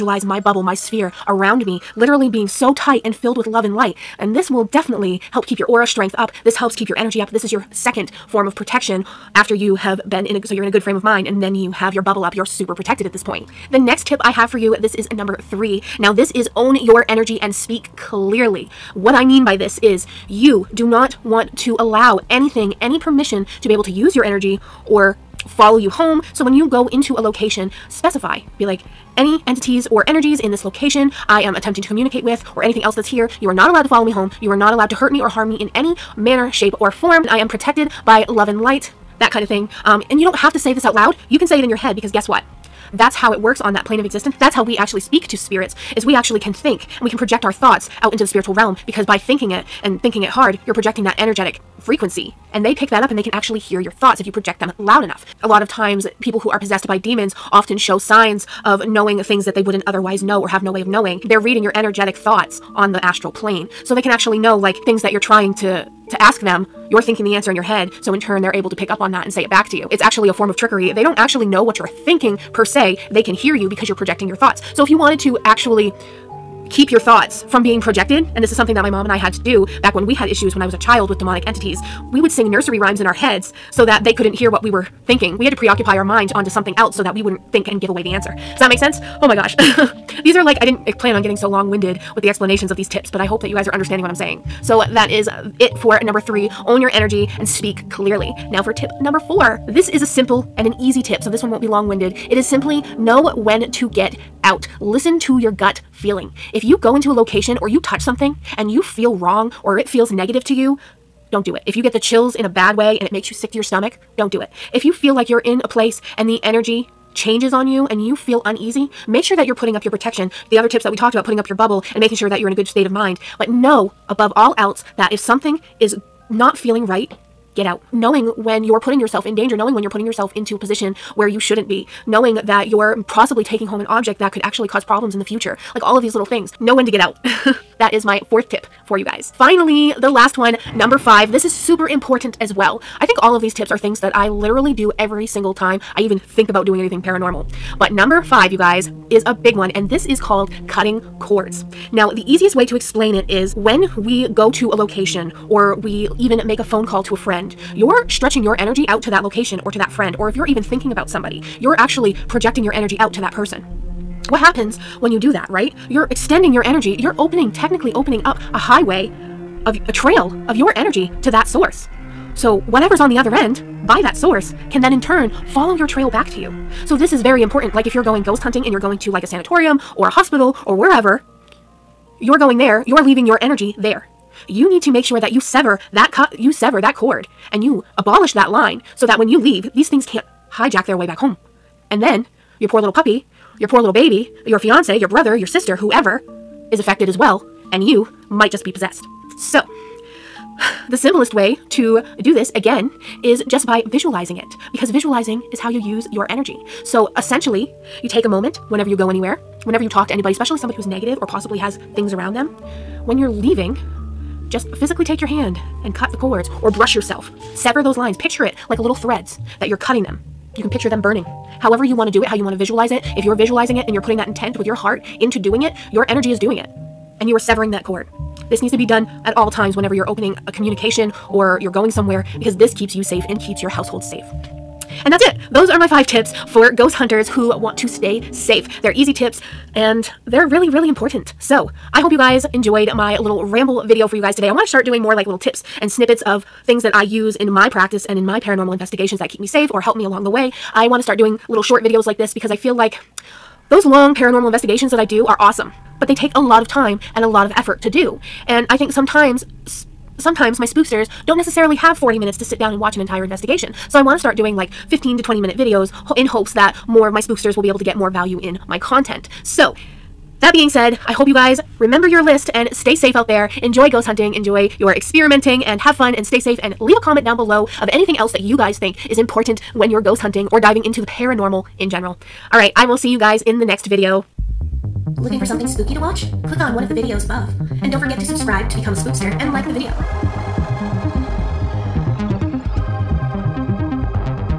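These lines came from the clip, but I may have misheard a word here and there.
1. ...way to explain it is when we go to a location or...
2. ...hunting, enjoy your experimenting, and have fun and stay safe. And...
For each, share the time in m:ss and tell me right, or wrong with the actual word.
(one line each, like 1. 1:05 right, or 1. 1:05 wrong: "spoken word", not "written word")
1. 2:32 right
2. 4:34 right.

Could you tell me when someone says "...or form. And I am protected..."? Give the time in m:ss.
0:36.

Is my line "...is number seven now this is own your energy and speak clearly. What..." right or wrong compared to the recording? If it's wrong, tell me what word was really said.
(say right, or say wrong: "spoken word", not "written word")
wrong: "three", not "seven".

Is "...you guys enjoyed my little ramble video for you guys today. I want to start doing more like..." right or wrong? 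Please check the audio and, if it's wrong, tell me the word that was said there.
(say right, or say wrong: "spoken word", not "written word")
right.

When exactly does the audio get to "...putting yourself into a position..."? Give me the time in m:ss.
2:09.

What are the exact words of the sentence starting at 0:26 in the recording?
So when you go into a location, specify.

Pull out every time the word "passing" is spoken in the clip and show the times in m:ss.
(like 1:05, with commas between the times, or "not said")
not said.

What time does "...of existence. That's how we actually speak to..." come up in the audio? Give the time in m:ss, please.
0:43.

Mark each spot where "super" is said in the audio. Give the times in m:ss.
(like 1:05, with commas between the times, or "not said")
0:12, 2:21.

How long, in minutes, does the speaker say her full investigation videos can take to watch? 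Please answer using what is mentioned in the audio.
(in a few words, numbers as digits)
40.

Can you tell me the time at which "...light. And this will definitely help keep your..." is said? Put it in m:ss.
0:03.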